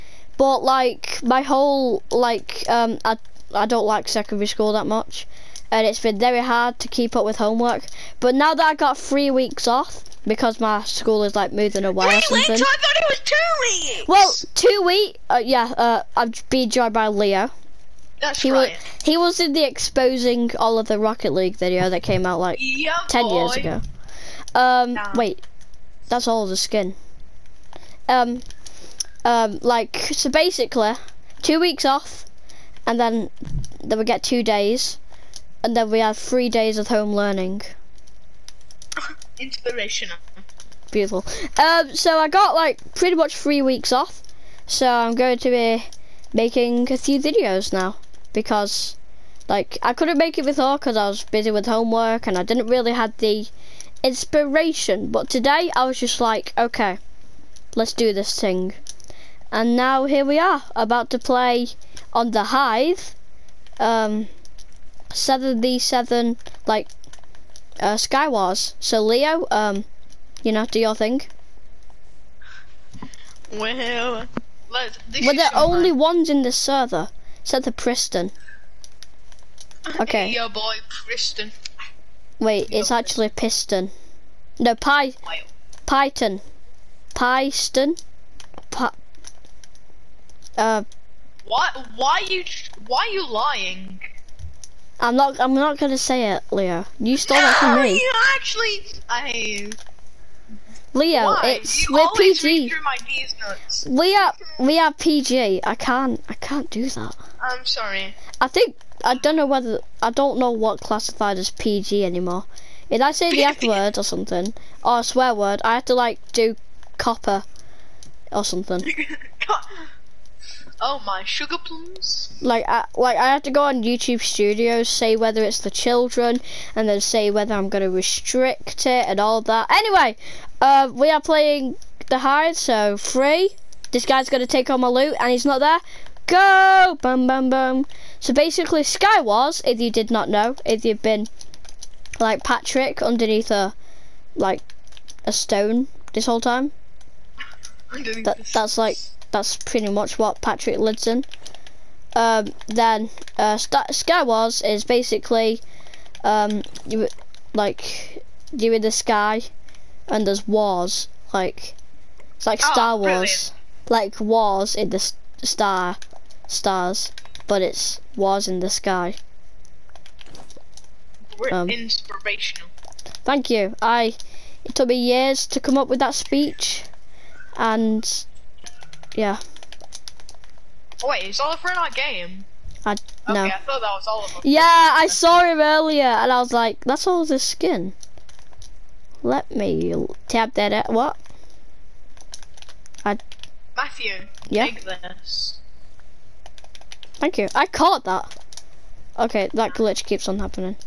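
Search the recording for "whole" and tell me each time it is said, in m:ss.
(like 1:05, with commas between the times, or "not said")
0:01, 2:26.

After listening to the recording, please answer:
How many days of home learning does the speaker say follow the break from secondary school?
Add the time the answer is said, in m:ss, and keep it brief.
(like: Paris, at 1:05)
3, at 0:36.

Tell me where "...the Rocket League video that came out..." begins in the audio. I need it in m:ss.
0:20.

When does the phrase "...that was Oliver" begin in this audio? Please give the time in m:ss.
3:03.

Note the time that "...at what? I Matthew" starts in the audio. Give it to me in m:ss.
3:10.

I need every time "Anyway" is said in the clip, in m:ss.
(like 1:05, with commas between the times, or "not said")
2:09.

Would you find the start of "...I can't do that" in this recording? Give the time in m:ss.
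1:46.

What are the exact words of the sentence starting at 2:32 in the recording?
Um, then uh, Sky Wars is basically um, you like you in the sky and there's wars.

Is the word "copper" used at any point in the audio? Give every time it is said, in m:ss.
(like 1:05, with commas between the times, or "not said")
1:56.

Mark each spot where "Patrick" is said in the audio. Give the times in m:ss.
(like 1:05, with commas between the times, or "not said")
2:22, 2:30.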